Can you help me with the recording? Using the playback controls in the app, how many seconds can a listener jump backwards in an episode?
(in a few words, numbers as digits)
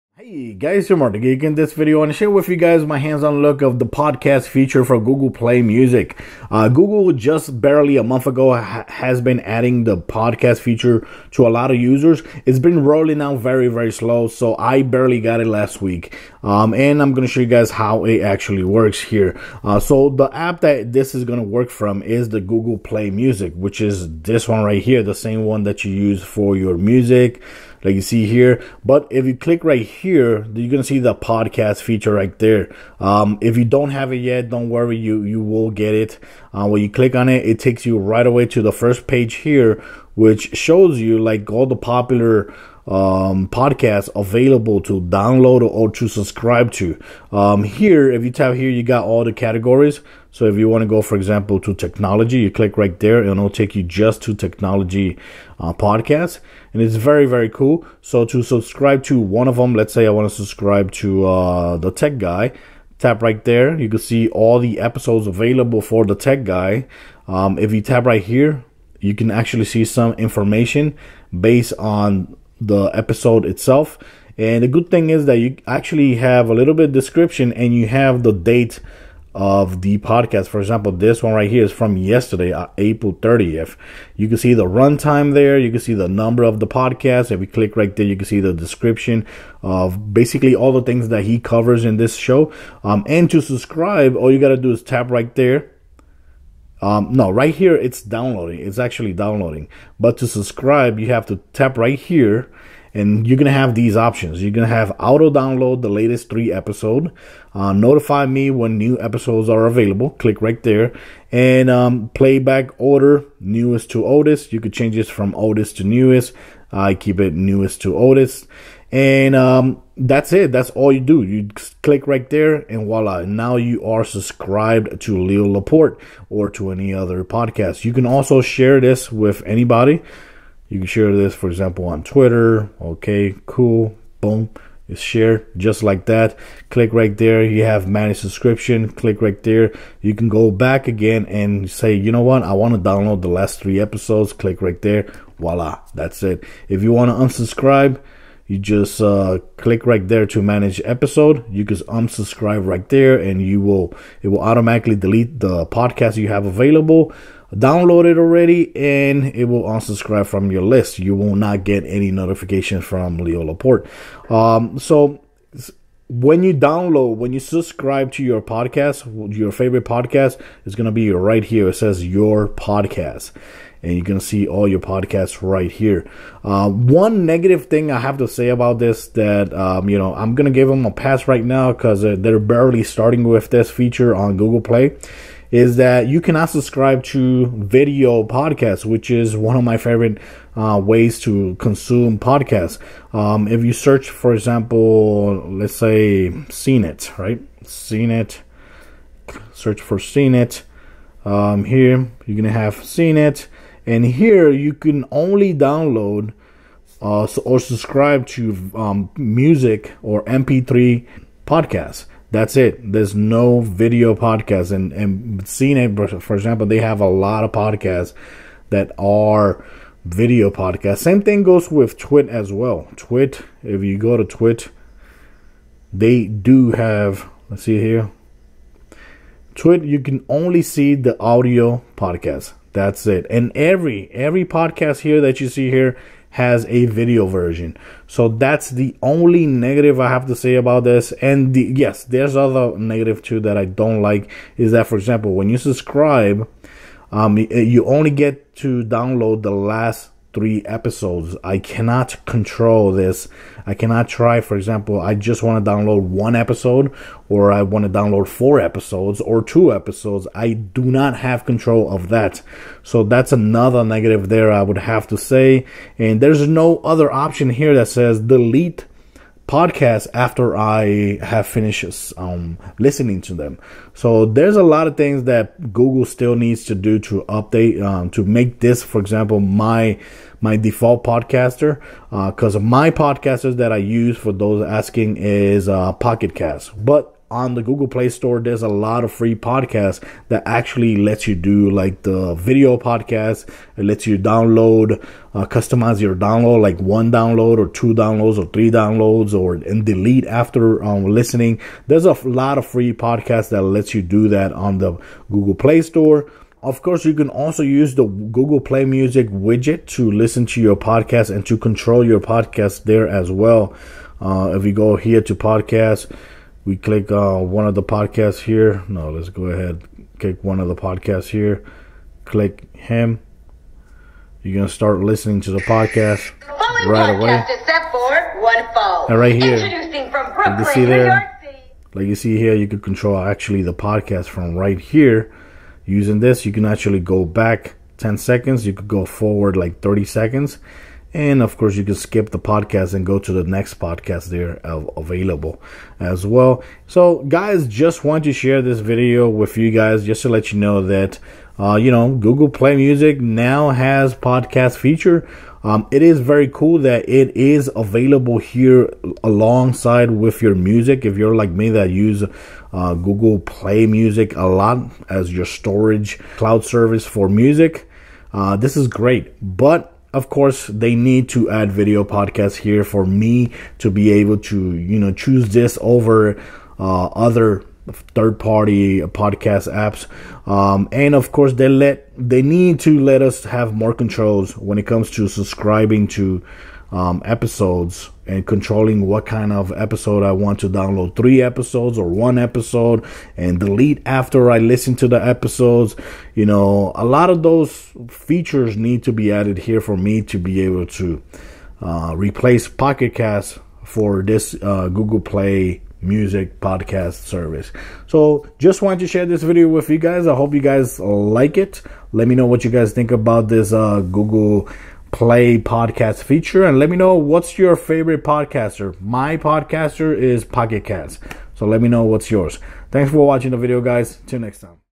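10.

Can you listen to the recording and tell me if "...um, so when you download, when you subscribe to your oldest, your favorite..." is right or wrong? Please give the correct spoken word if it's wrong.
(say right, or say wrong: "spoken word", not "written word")
wrong: "podcast", not "oldest".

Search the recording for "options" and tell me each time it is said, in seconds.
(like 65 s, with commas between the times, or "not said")
103 s, 267 s.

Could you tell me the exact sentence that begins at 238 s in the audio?
So that's the only negative I have to say about this.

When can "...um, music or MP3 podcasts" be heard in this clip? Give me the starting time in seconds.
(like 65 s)
208 s.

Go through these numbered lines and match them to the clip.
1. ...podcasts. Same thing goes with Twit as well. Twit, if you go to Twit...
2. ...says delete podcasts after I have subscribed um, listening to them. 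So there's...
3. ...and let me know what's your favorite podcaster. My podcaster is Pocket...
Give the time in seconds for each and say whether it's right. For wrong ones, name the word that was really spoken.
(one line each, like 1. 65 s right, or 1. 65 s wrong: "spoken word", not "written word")
1. 220 s right
2. 267 s wrong: "finished", not "subscribed"
3. 416 s right.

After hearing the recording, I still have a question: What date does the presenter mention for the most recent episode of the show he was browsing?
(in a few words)
April 30th.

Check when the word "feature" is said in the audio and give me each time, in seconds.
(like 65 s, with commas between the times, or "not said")
4 s, 10 s, 31 s, 183 s, 354 s, 398 s, 416 s.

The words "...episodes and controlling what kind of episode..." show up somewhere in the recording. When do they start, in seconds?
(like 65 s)
387 s.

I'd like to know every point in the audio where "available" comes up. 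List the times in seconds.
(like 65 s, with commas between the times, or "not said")
44 s, 65 s, 109 s, 156 s, 344 s, 357 s.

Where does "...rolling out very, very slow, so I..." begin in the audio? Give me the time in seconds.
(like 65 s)
12 s.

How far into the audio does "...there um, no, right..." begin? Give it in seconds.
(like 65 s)
95 s.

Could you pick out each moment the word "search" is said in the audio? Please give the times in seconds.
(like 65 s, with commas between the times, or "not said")
193 s, 199 s.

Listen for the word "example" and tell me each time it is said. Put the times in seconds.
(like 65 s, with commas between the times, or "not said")
51 s, 80 s, 131 s, 194 s, 216 s, 244 s, 254 s, 278 s.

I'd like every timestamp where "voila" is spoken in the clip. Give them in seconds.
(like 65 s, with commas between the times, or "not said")
122 s, 145 s.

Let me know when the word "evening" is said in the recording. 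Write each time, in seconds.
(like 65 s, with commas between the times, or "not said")
not said.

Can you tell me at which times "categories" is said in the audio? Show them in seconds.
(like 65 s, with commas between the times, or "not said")
49 s.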